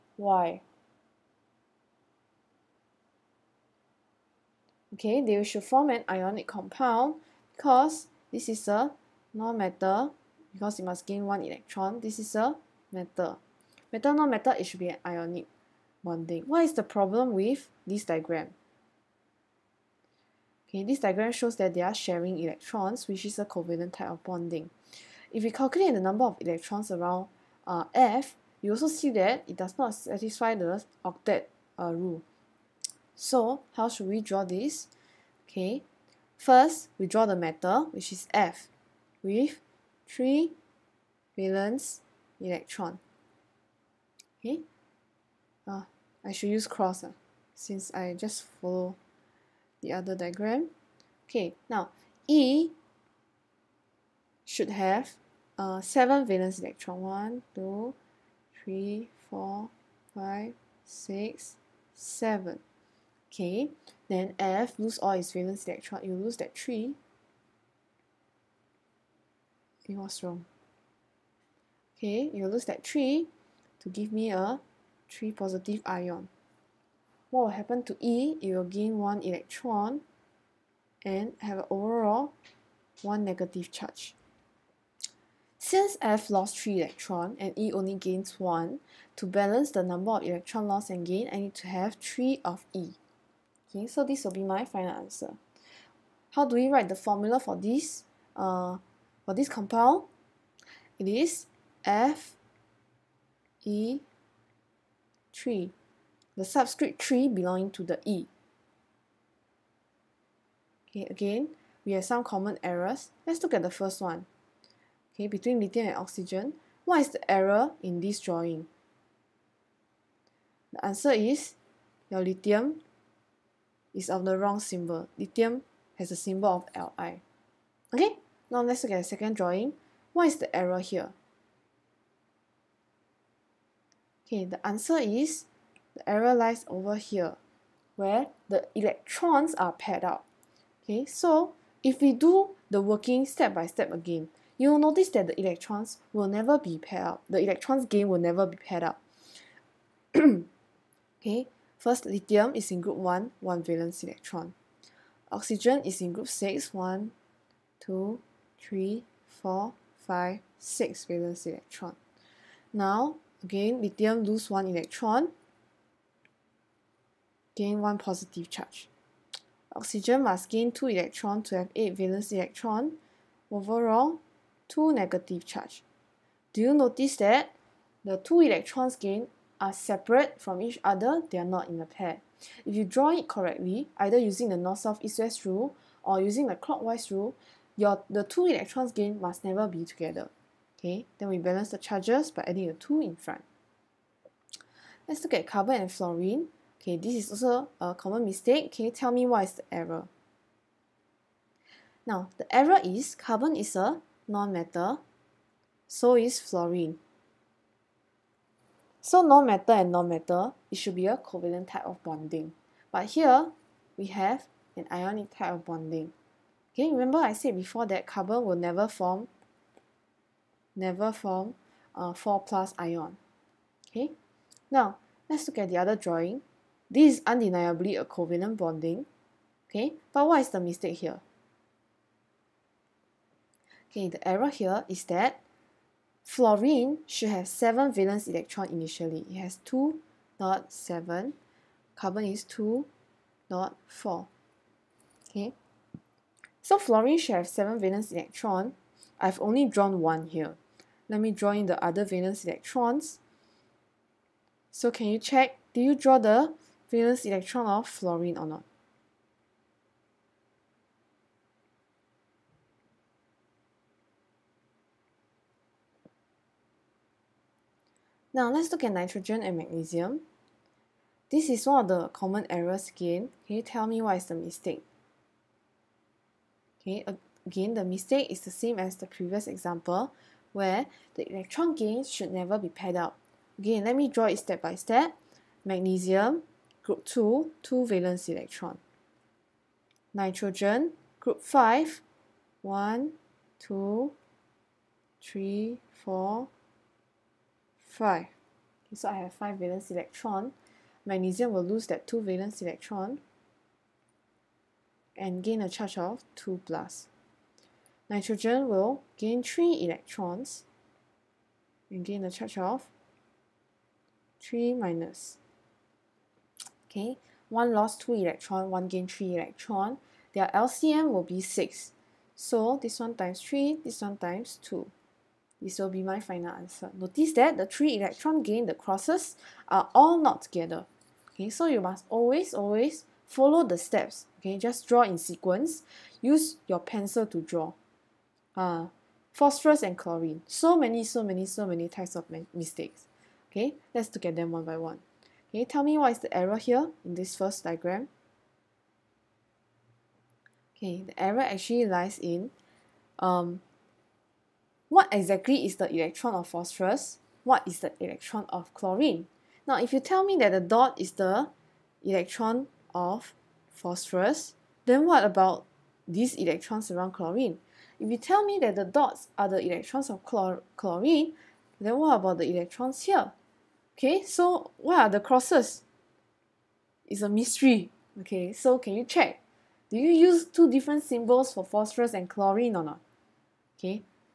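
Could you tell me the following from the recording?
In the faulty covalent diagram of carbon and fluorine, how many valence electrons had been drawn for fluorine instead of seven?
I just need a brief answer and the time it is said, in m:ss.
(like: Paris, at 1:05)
2, at 3:59.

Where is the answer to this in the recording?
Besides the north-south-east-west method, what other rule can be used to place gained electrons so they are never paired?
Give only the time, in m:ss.
3:06.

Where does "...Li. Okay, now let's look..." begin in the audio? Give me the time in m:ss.
2:06.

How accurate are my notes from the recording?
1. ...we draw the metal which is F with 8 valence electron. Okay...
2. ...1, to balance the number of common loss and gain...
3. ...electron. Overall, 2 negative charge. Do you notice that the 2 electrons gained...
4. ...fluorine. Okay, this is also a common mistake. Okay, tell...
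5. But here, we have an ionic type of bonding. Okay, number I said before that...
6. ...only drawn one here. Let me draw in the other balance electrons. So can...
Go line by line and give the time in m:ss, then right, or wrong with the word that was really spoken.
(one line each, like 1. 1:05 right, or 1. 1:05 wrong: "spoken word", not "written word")
1. 0:36 wrong: "3", not "8"
2. 1:28 wrong: "electron", not "common"
3. 2:52 right
4. 3:15 right
5. 3:32 wrong: "remember", not "number"
6. 4:09 wrong: "valence", not "balance".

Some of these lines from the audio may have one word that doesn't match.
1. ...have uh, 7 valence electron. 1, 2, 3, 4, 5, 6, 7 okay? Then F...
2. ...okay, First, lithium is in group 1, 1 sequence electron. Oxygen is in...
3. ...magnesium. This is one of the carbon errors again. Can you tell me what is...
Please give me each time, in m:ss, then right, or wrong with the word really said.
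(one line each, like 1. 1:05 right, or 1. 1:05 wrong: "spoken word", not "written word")
1. 0:54 right
2. 2:30 wrong: "valence", not "sequence"
3. 4:29 wrong: "common", not "carbon".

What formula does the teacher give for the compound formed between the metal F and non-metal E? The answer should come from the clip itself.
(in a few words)
FE3.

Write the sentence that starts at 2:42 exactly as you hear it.
Now, again, lithium lose 1 electron, gain 1 positive charge.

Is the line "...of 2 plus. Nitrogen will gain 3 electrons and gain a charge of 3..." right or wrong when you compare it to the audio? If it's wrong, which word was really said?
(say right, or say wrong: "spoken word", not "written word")
right.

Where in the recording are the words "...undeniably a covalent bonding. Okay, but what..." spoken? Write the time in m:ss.
3:47.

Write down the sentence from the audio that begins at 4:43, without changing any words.
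Again, let me draw it step by step.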